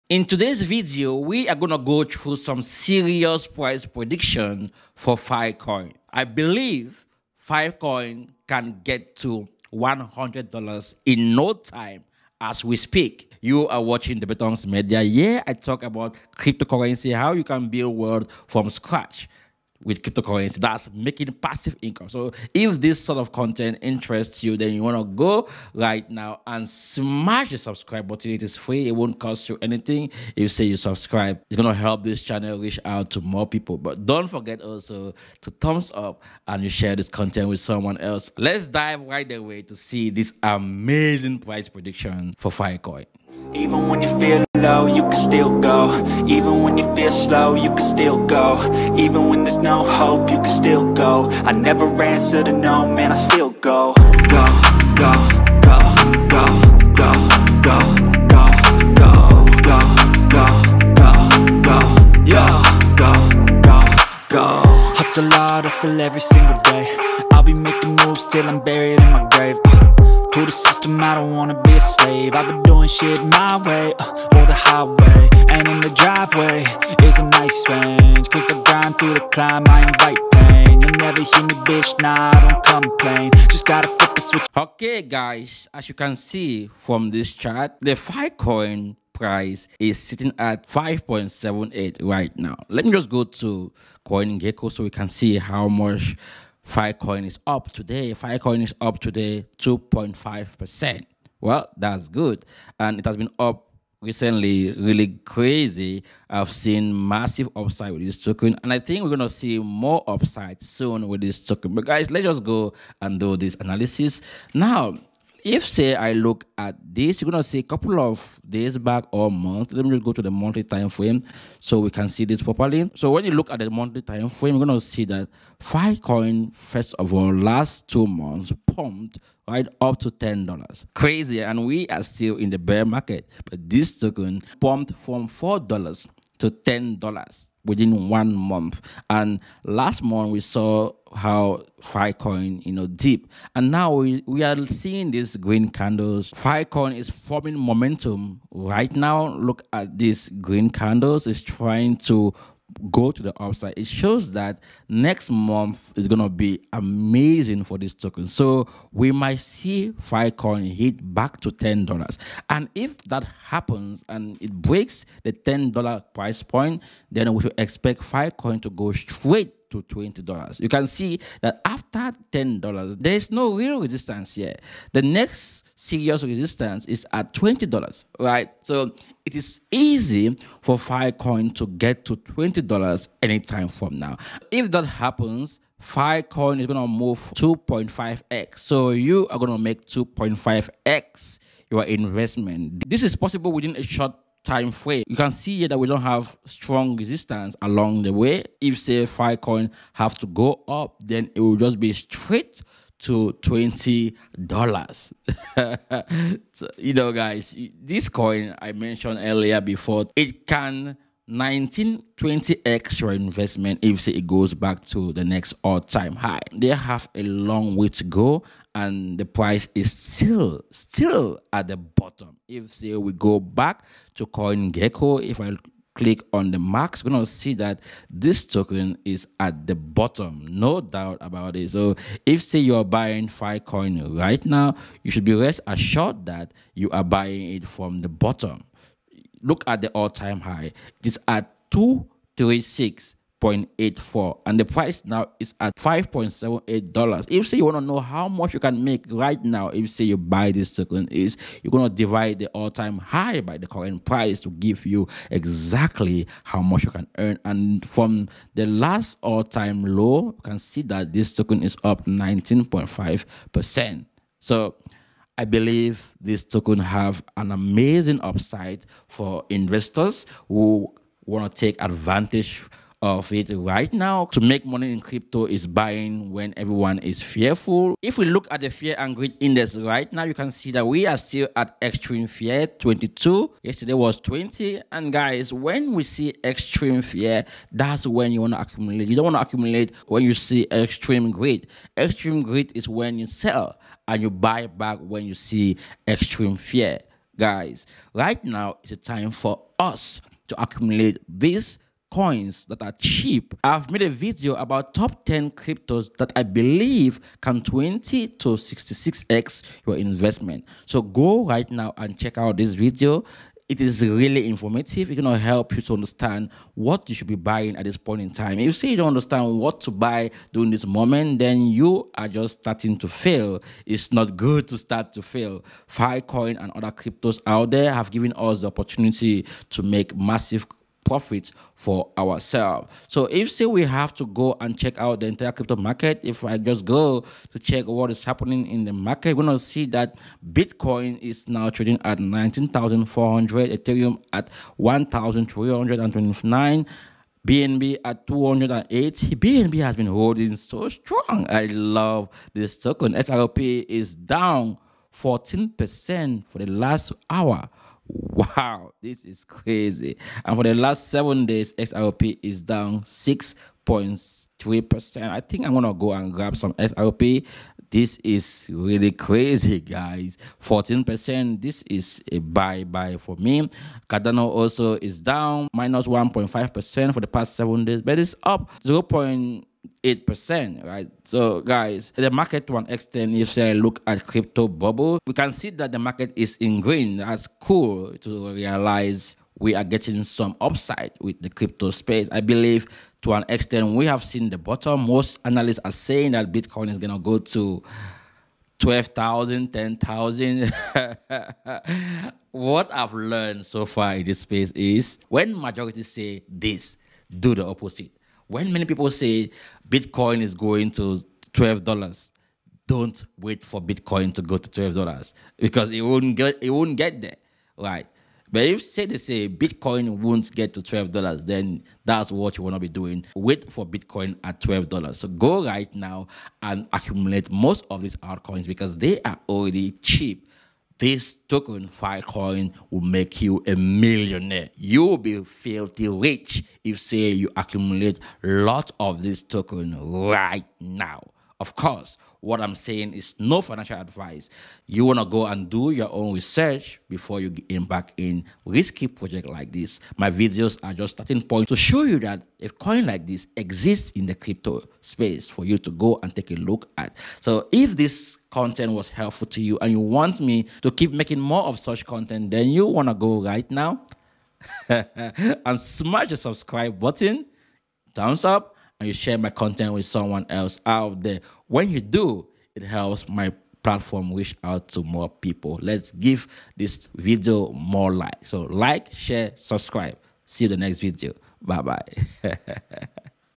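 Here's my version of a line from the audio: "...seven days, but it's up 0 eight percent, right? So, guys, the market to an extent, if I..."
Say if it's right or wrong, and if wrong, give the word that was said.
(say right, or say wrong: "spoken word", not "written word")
right.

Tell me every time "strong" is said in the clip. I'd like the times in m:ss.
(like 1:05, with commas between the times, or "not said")
3:16, 5:50.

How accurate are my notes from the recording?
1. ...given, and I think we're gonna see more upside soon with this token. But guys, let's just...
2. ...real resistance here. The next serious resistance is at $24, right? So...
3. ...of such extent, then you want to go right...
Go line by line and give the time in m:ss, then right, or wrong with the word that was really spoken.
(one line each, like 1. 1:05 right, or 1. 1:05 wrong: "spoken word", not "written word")
1. 1:48 wrong: "token", not "given"
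2. 2:53 wrong: "20", not "24"
3. 7:41 wrong: "content", not "extent".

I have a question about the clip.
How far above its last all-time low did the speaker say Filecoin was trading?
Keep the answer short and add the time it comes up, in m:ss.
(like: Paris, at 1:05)
19.5%, at 4:22.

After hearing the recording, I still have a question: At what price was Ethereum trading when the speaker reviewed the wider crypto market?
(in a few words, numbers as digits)
$1,329.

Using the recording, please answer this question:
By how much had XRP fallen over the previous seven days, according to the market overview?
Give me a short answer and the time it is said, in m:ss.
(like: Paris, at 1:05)
6.3%, at 6:02.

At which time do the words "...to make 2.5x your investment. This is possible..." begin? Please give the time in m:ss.
3:09.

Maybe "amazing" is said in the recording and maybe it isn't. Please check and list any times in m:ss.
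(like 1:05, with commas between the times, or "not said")
0:40, 2:36, 4:27.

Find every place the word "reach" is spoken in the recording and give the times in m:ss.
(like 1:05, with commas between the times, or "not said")
0:32, 7:54.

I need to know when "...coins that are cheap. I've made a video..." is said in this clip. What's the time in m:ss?
5:02.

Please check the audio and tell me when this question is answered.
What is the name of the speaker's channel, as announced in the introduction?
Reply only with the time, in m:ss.
0:14.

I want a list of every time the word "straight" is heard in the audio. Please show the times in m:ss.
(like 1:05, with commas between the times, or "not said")
2:48, 3:21.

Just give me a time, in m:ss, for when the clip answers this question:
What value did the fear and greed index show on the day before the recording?
4:43.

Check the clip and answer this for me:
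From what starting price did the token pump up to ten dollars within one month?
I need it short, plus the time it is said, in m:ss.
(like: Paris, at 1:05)
$4, at 2:15.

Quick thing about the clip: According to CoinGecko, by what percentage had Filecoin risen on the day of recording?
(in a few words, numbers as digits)
2.5%.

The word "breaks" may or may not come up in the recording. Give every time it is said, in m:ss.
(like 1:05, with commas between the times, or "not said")
2:44.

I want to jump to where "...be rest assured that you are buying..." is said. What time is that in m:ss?
3:55.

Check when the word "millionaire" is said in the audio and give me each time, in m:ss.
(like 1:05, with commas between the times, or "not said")
7:13.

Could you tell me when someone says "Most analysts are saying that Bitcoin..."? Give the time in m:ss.
6:35.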